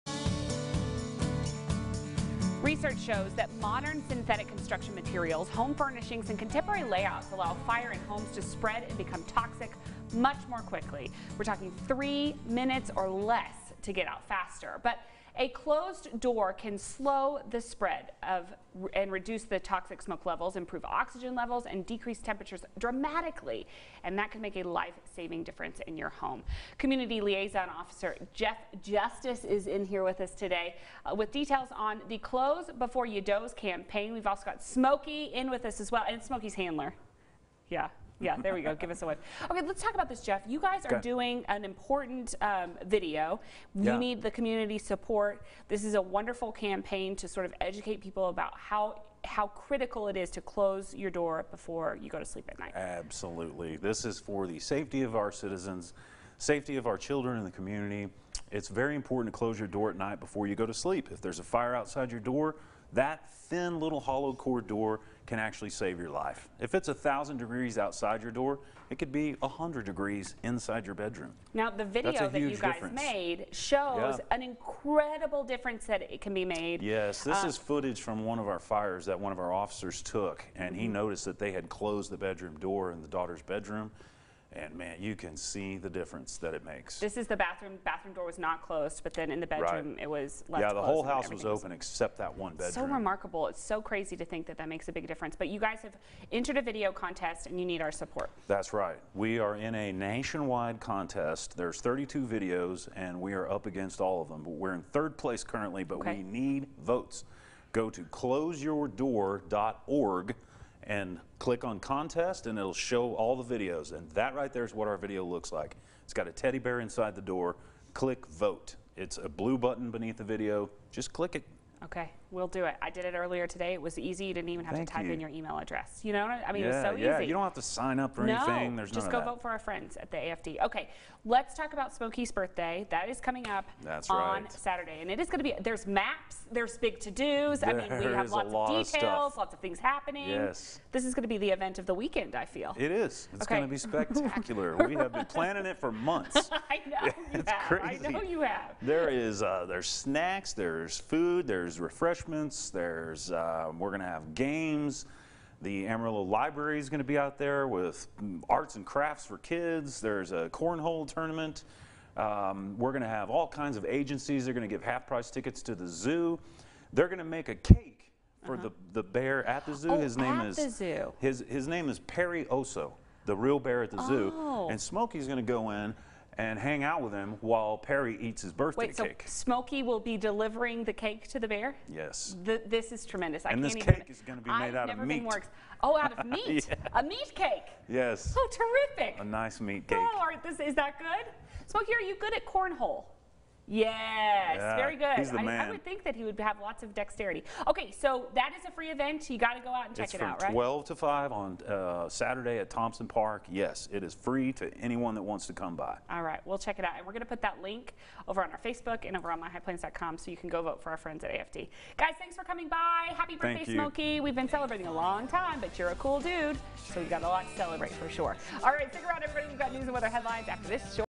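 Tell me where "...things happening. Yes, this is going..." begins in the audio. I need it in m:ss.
2:19.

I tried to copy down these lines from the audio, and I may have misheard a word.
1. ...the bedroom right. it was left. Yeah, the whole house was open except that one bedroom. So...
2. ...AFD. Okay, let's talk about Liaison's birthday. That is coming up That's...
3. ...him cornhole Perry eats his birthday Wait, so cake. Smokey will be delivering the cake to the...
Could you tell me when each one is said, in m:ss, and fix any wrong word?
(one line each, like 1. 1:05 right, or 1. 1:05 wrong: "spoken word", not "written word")
1. 1:29 right
2. 2:10 wrong: "Smokey", not "Liaison"
3. 2:57 wrong: "while", not "cornhole".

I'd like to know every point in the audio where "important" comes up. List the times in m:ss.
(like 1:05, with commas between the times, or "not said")
0:41, 0:58.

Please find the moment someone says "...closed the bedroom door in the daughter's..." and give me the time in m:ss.
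1:21.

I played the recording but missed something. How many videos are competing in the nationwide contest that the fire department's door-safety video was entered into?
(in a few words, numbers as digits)
32.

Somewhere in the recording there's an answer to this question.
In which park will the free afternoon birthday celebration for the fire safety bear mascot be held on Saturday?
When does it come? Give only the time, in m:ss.
3:22.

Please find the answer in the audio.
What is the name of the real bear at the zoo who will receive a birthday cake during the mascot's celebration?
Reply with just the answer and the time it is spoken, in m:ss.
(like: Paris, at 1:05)
Perry Oso, at 2:51.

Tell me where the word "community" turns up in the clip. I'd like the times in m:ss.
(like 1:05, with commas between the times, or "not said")
0:26, 0:44, 0:57.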